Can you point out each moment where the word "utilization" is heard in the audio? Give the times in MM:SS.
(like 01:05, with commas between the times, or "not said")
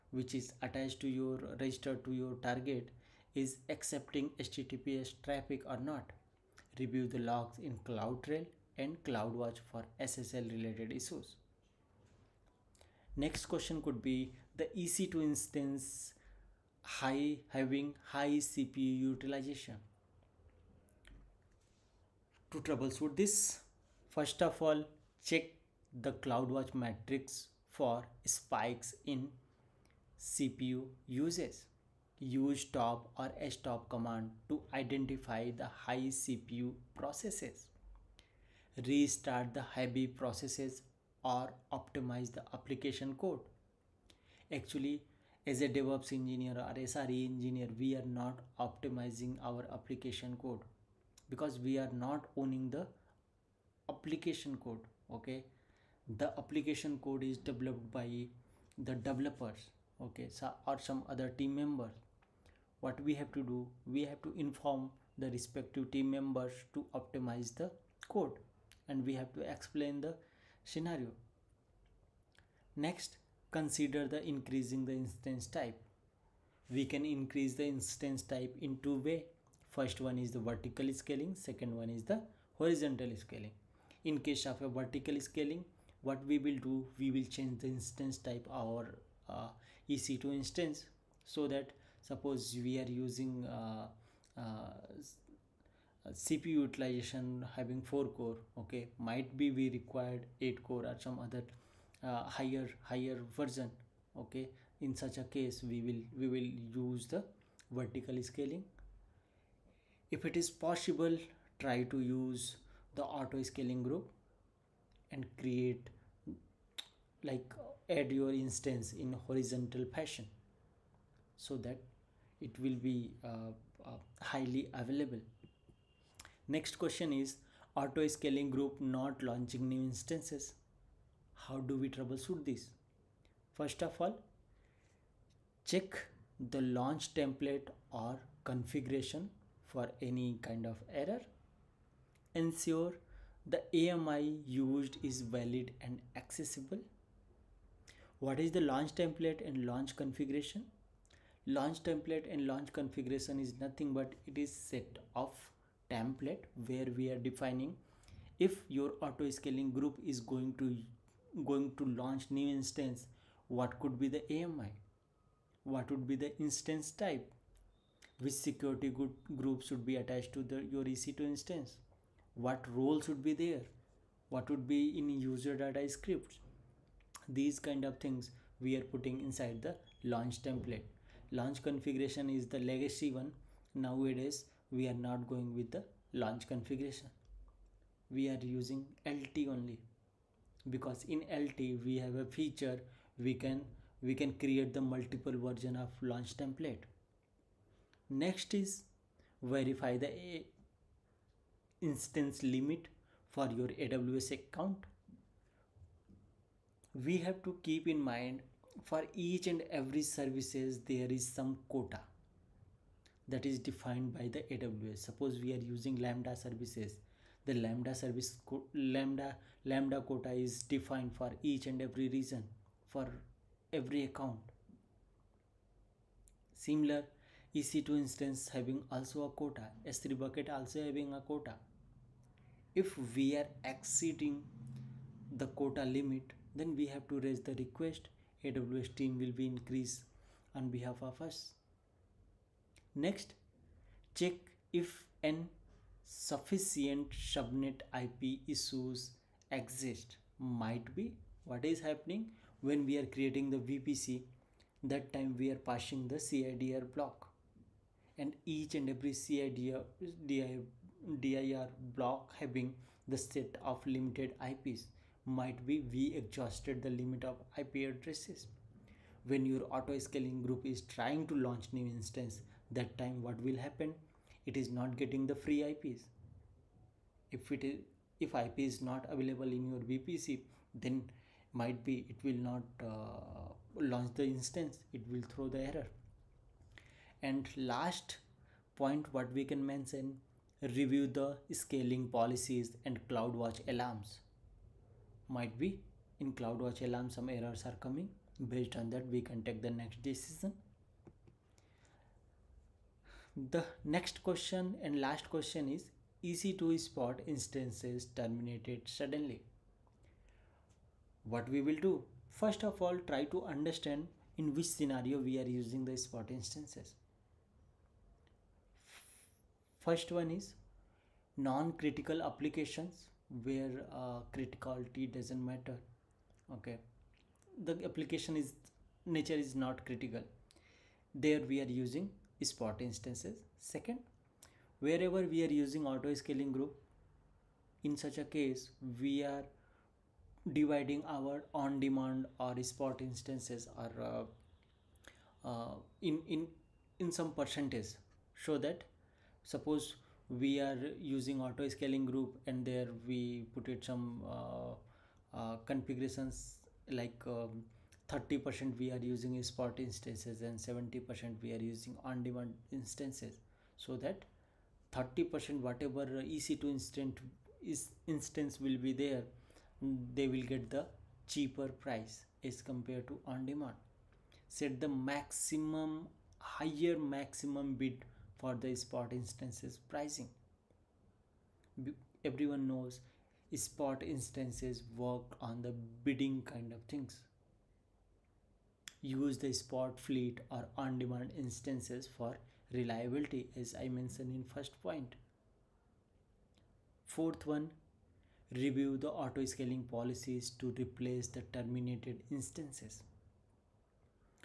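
00:19, 01:36.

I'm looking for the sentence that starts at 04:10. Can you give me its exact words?
Might be what is happening when we are creating the VPC, that time we are passing the CIDR block.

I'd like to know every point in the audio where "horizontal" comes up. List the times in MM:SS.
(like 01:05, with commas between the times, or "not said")
01:22, 01:59.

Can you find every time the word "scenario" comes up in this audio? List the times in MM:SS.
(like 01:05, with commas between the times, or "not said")
01:10, 05:14.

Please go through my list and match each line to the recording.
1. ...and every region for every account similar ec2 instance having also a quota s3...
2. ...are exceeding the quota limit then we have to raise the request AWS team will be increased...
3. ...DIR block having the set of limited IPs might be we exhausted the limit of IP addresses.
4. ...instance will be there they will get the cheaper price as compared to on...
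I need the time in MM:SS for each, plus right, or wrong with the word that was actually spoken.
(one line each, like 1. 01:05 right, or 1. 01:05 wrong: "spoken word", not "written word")
1. 03:41 right
2. 03:53 right
3. 04:20 right
4. 06:08 right.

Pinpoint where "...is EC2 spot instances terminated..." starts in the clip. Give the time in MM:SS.
05:05.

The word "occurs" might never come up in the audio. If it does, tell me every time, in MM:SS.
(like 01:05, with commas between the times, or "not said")
not said.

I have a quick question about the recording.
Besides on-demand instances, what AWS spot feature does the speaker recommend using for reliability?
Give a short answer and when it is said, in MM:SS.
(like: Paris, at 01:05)
Spot fleet, at 06:29.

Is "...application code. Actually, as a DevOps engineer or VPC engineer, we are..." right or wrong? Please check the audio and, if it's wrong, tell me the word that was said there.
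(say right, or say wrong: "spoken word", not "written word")
wrong: "SRE", not "VPC".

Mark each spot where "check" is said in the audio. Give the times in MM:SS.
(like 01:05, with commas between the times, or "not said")
00:25, 02:15, 04:04.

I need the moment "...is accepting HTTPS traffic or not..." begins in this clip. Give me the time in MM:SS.
00:03.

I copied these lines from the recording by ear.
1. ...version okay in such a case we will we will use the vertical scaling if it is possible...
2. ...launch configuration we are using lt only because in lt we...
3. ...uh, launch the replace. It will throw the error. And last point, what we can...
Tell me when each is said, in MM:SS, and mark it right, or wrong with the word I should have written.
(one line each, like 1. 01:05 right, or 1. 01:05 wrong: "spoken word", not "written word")
1. 01:43 right
2. 03:06 right
3. 04:42 wrong: "instance", not "replace".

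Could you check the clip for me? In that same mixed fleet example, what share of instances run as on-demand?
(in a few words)
70%.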